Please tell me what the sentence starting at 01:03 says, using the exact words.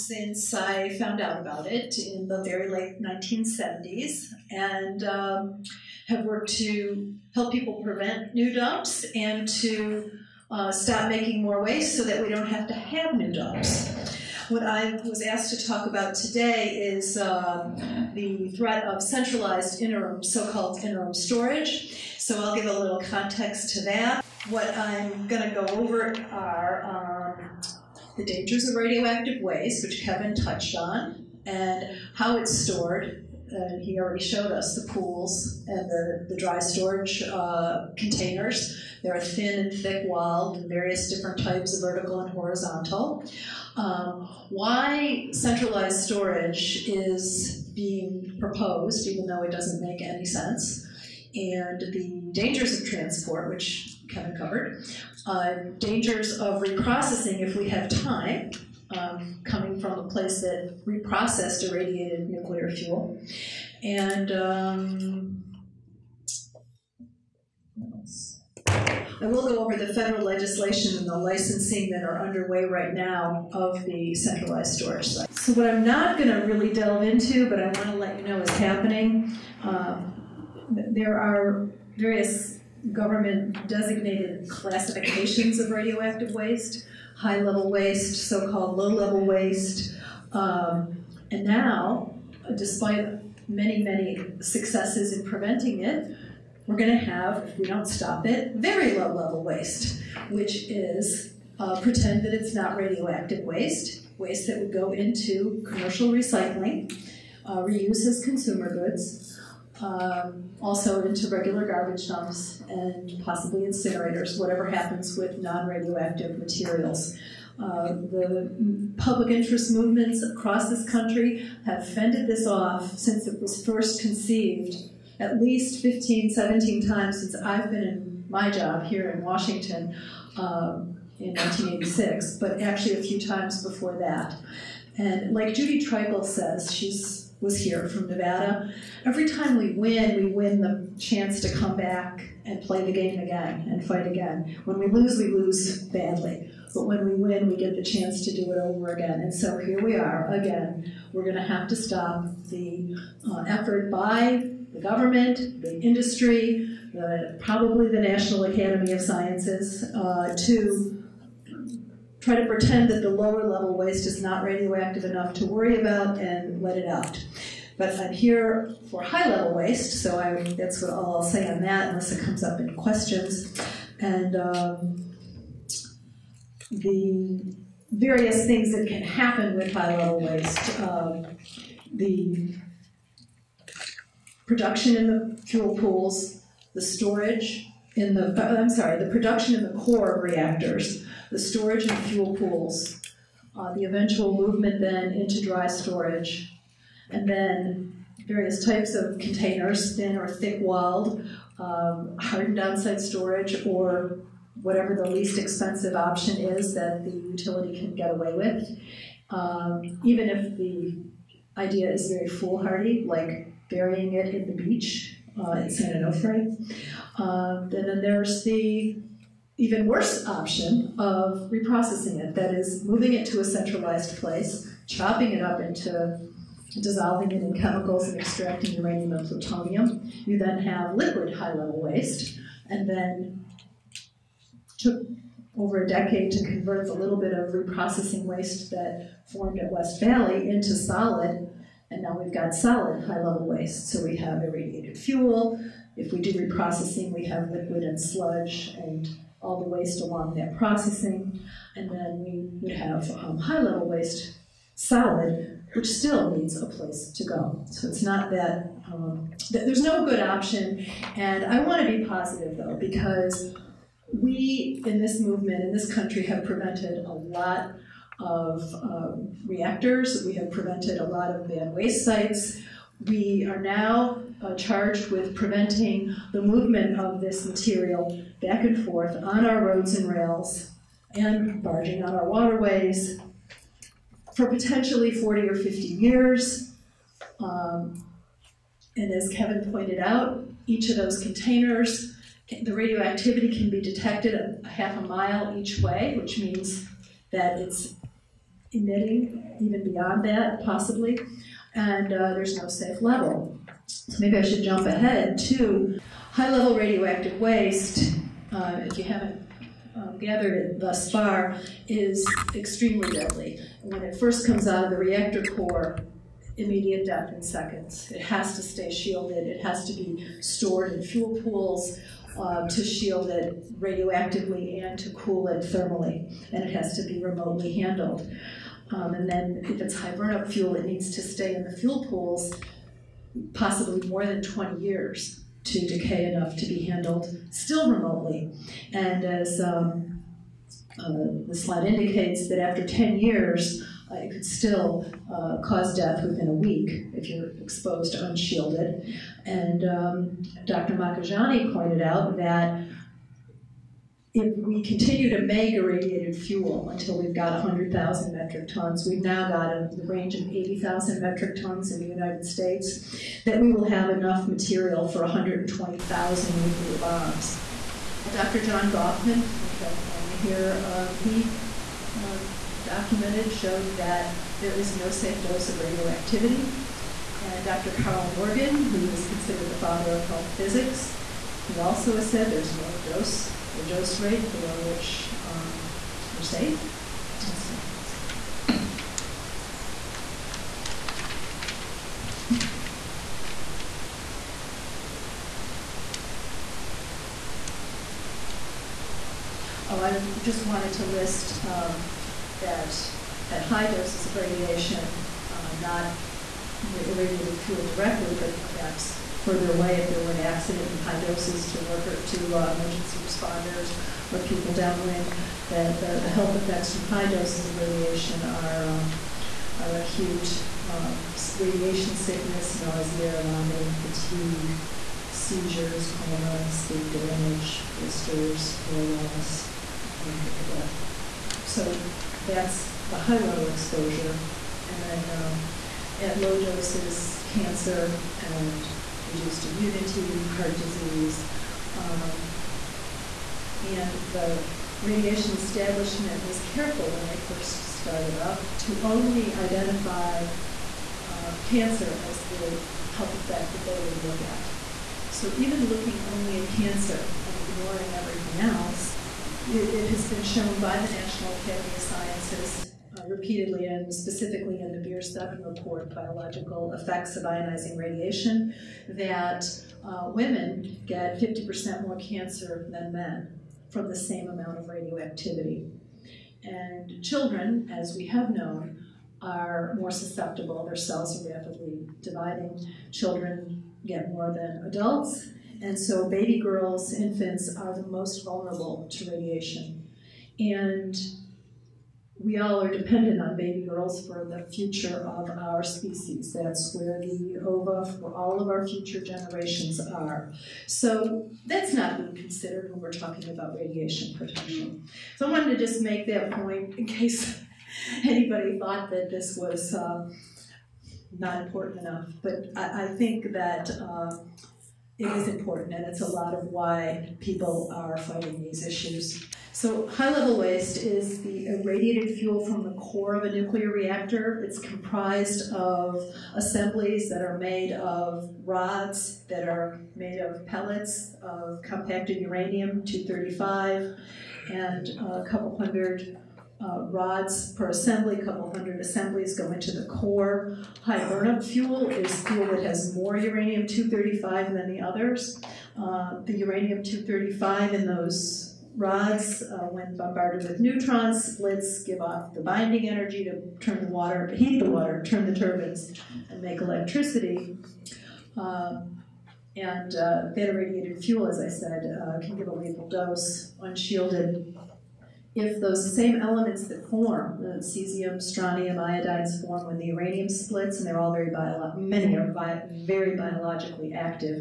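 And um, I will go over the federal legislation and the licensing that are underway right now of the centralized storage site.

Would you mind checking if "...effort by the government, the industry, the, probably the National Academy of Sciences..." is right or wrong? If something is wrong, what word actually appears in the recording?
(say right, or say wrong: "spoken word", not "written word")
right.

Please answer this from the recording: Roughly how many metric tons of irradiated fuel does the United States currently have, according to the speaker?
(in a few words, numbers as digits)
80,000.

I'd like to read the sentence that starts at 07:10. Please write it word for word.
Uh, so that's the high level exposure.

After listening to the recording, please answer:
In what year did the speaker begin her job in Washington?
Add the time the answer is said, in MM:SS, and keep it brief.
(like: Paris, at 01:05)
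1986, at 02:11.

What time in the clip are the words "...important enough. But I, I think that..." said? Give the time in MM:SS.
08:31.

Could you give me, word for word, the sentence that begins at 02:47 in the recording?
But I'm here for high level waste, so I, that's what I'll say on that, unless it comes up in questions.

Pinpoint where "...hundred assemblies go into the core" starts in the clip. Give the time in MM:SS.
08:58.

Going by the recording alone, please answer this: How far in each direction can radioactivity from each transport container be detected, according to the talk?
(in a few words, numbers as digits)
half a mile.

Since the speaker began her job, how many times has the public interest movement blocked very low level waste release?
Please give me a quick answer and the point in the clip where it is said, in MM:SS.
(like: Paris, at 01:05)
15, 17 times, at 02:05.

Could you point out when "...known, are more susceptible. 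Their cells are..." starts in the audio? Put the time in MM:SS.
07:58.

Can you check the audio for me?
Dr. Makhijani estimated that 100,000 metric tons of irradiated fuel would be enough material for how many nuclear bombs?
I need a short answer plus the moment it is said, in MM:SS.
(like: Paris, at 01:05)
120,000, at 06:05.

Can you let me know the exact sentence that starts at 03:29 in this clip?
Um, even if the idea is very foolhardy, like burying it in the beach uh, an San Onofre.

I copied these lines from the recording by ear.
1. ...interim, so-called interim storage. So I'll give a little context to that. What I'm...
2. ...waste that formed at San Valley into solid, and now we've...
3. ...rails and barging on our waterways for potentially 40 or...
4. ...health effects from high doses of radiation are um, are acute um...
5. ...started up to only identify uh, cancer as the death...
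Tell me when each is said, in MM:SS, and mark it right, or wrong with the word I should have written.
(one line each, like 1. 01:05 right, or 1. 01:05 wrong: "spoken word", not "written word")
1. 00:19 right
2. 03:58 wrong: "West", not "San"
3. 04:40 right
4. 06:56 right
5. 07:27 wrong: "health", not "death".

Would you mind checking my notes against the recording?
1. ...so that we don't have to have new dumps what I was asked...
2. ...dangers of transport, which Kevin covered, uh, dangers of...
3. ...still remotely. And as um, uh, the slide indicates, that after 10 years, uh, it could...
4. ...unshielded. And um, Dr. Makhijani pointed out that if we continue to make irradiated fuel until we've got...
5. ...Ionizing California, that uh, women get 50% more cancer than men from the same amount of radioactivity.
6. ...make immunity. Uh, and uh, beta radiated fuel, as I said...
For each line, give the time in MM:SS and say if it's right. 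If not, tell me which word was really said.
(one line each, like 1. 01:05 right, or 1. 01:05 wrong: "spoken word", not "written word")
1. 00:11 right
2. 00:52 right
3. 05:37 right
4. 05:48 right
5. 07:47 wrong: "Radiation", not "California"
6. 09:16 wrong: "electricity", not "immunity".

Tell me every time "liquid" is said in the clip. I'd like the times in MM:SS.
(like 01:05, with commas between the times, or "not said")
03:50, 04:07.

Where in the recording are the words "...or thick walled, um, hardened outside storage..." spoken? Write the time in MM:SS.
03:20.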